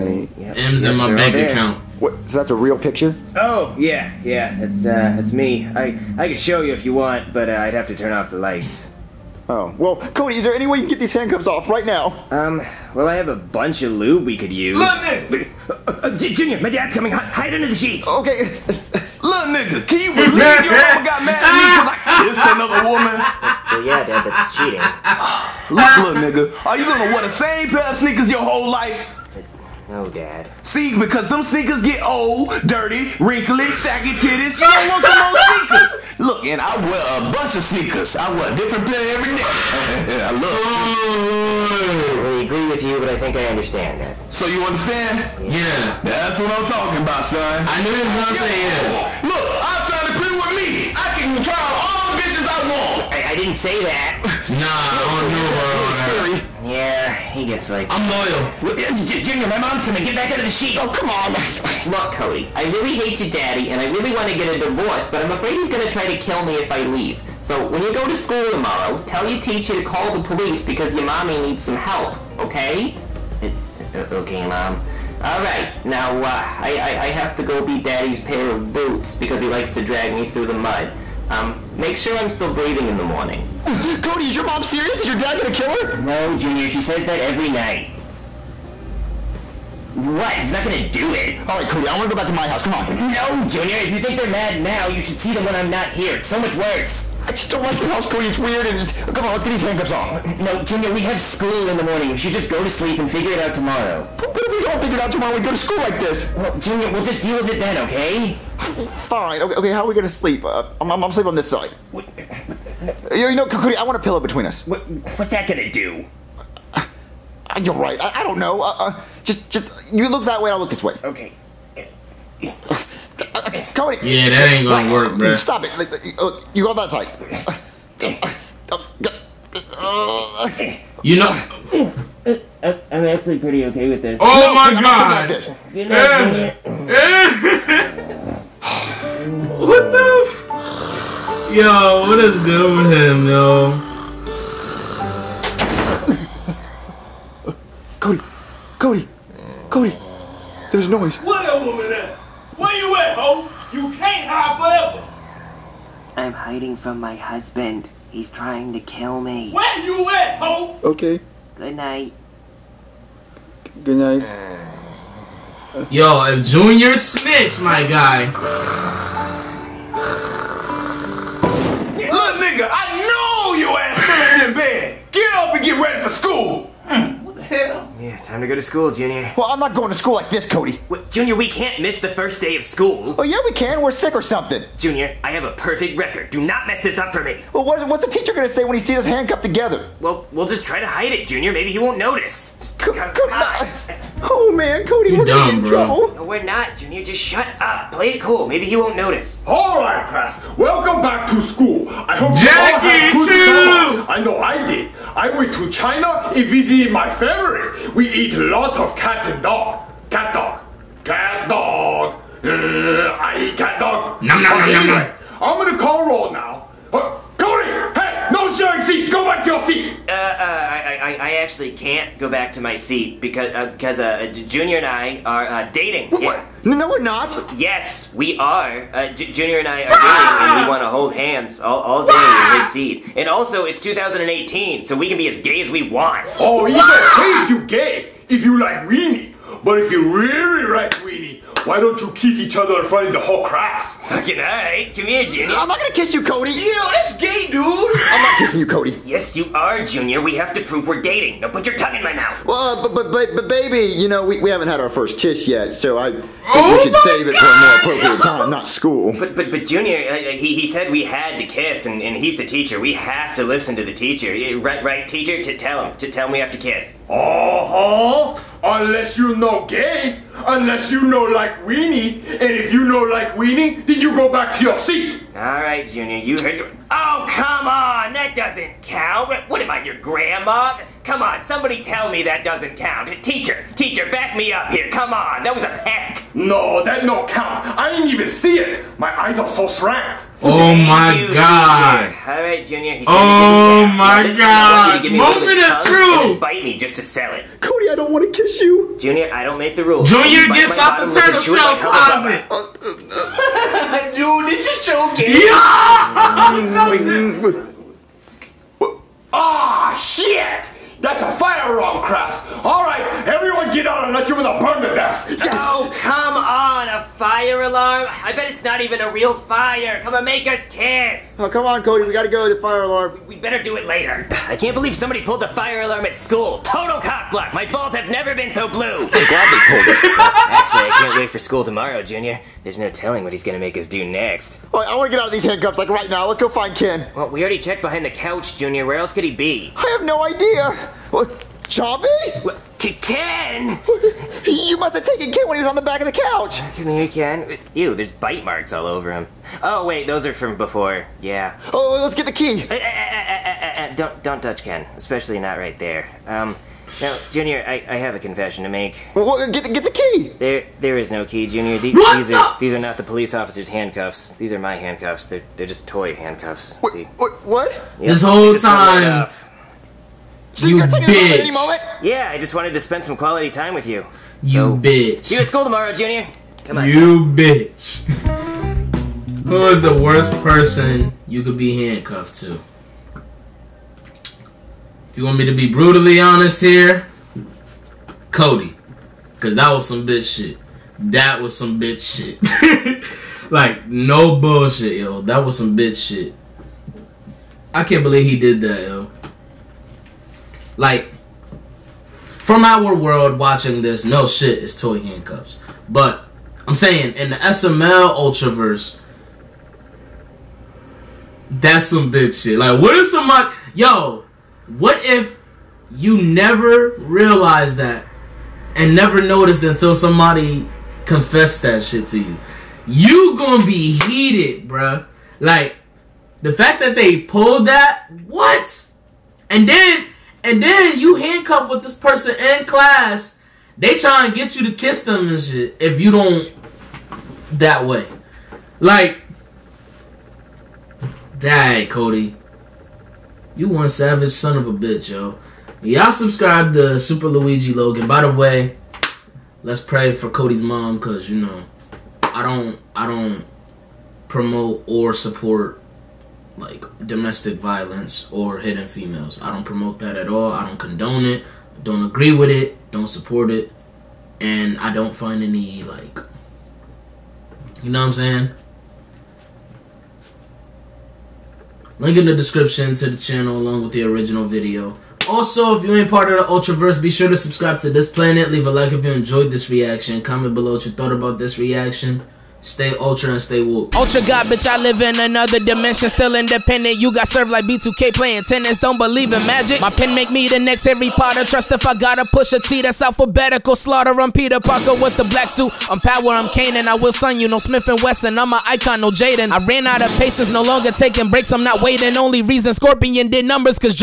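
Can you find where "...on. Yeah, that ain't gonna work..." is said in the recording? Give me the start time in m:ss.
2:03.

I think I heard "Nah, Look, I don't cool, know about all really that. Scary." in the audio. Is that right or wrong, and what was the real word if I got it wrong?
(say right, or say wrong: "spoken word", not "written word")
right.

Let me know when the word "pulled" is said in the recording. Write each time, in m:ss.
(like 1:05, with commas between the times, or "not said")
5:25, 5:29, 7:07.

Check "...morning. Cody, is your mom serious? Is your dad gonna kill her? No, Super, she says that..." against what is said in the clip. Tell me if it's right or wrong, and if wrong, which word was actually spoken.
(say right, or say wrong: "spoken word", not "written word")
wrong: "Junior", not "Super".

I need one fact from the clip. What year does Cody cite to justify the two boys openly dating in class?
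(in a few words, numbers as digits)
2018.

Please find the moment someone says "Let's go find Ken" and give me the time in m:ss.
5:36.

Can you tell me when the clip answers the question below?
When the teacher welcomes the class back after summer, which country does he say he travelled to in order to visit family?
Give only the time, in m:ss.
3:25.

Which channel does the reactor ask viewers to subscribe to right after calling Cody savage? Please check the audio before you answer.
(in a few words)
Super Luigi Logan.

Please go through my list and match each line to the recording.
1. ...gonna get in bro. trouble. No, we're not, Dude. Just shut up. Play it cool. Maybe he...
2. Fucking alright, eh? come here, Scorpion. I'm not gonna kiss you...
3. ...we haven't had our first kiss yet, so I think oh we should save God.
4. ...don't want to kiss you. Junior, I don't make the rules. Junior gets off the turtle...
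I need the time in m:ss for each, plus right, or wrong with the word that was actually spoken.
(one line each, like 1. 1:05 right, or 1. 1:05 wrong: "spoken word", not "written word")
1. 3:15 wrong: "Junior", not "Dude"
2. 4:04 wrong: "Junior", not "Scorpion"
3. 4:14 right
4. 4:57 right.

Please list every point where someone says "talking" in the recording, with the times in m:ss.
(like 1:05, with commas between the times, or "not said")
0:46.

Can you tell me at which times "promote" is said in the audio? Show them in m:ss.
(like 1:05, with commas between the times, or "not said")
7:34, 7:39.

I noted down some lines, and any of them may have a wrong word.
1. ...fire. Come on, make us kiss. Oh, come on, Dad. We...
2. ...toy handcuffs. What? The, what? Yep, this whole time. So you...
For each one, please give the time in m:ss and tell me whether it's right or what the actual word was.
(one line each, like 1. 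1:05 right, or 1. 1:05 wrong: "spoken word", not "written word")
1. 5:19 wrong: "Cody", not "Dad"
2. 6:05 right.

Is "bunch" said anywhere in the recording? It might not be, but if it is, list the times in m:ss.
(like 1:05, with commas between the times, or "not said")
0:13, 0:37.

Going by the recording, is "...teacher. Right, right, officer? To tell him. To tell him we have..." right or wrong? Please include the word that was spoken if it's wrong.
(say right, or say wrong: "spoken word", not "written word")
wrong: "teacher", not "officer".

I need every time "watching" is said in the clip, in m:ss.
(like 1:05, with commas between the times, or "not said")
6:43.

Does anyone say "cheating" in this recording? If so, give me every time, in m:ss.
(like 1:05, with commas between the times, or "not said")
0:24.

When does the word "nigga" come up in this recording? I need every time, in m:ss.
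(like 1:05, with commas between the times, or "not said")
0:14, 0:19, 0:26.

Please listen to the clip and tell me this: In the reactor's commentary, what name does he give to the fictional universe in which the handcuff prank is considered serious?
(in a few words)
SML Ultraverse.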